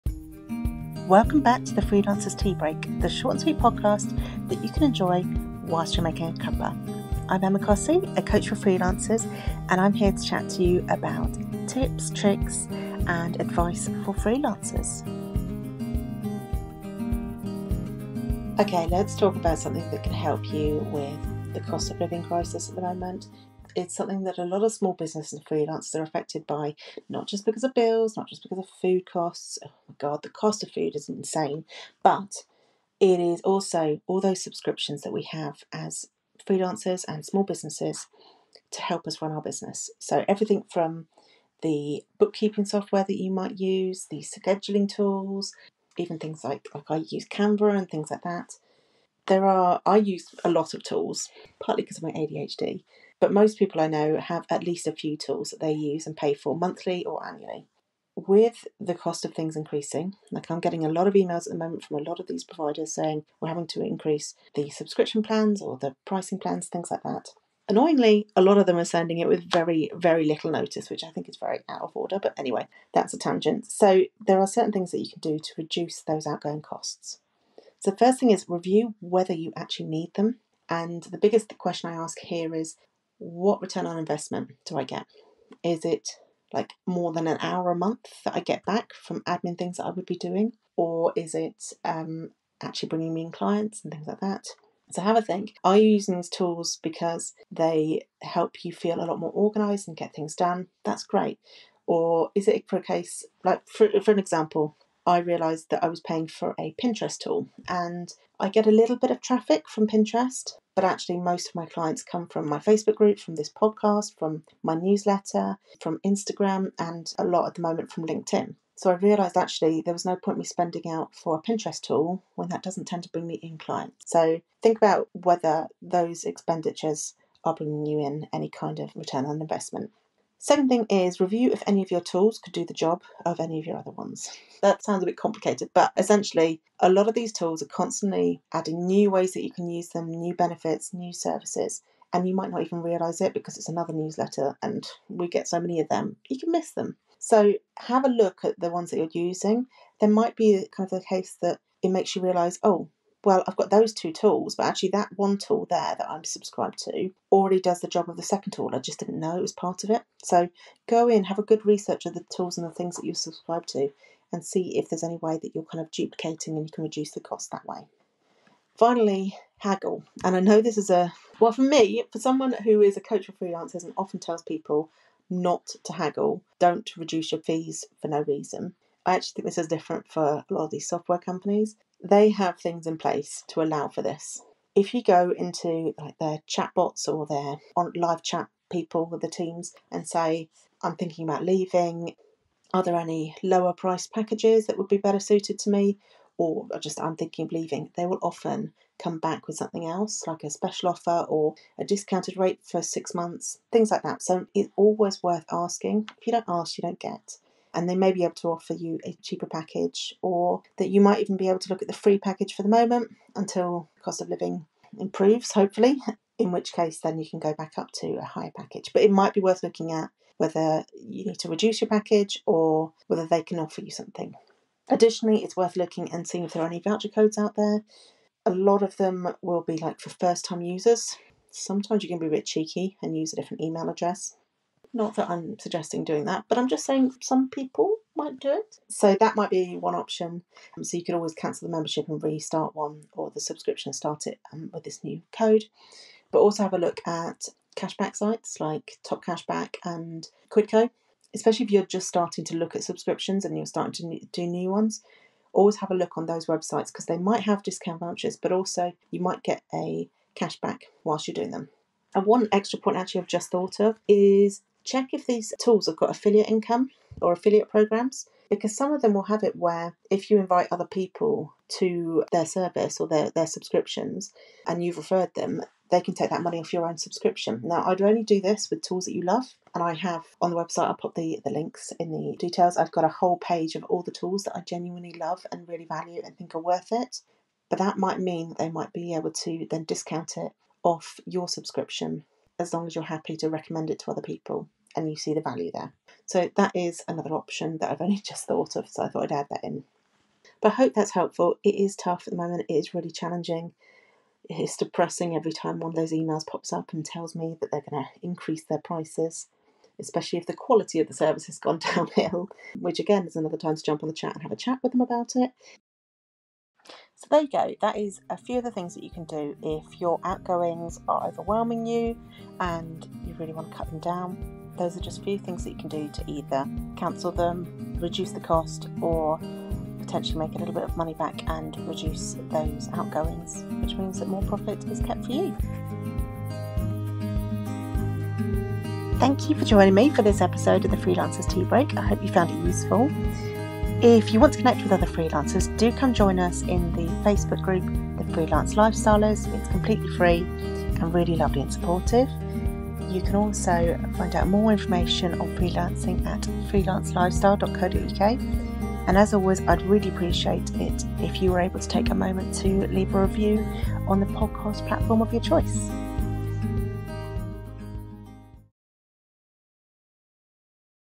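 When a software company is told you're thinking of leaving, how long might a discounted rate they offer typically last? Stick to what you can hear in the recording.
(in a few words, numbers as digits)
6 months.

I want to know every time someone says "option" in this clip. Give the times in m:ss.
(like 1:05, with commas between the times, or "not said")
3:59, 4:57.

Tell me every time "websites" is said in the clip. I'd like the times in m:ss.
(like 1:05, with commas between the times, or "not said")
4:16, 4:40.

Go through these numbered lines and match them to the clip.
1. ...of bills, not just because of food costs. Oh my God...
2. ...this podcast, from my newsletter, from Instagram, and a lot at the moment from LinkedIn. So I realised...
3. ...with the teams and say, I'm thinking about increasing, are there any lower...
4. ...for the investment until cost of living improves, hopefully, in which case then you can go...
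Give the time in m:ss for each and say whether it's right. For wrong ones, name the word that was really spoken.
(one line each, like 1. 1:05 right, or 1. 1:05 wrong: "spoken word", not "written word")
1. 0:27 right
2. 1:53 right
3. 3:09 wrong: "leaving", not "increasing"
4. 3:32 wrong: "moment", not "investment".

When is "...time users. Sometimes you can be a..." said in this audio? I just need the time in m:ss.
3:50.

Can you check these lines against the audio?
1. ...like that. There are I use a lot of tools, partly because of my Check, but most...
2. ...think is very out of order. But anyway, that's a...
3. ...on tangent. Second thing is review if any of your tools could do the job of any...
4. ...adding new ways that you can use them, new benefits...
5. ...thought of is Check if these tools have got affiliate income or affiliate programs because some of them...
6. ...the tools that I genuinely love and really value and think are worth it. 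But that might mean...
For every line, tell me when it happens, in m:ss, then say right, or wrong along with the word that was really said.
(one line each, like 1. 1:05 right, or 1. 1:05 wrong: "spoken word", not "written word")
1. 0:48 wrong: "ADHD", not "Check"
2. 1:11 right
3. 2:09 wrong: "investment", not "tangent"
4. 2:18 right
5. 4:23 right
6. 4:44 right.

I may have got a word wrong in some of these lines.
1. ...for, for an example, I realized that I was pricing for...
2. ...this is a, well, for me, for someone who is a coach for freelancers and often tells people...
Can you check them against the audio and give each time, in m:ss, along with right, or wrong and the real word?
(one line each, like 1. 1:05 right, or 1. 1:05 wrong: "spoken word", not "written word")
1. 1:43 wrong: "paying", not "pricing"
2. 2:50 right.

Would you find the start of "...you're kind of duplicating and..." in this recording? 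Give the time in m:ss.
2:45.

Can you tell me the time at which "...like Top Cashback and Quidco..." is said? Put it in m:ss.
4:08.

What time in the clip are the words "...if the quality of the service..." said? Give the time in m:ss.
5:10.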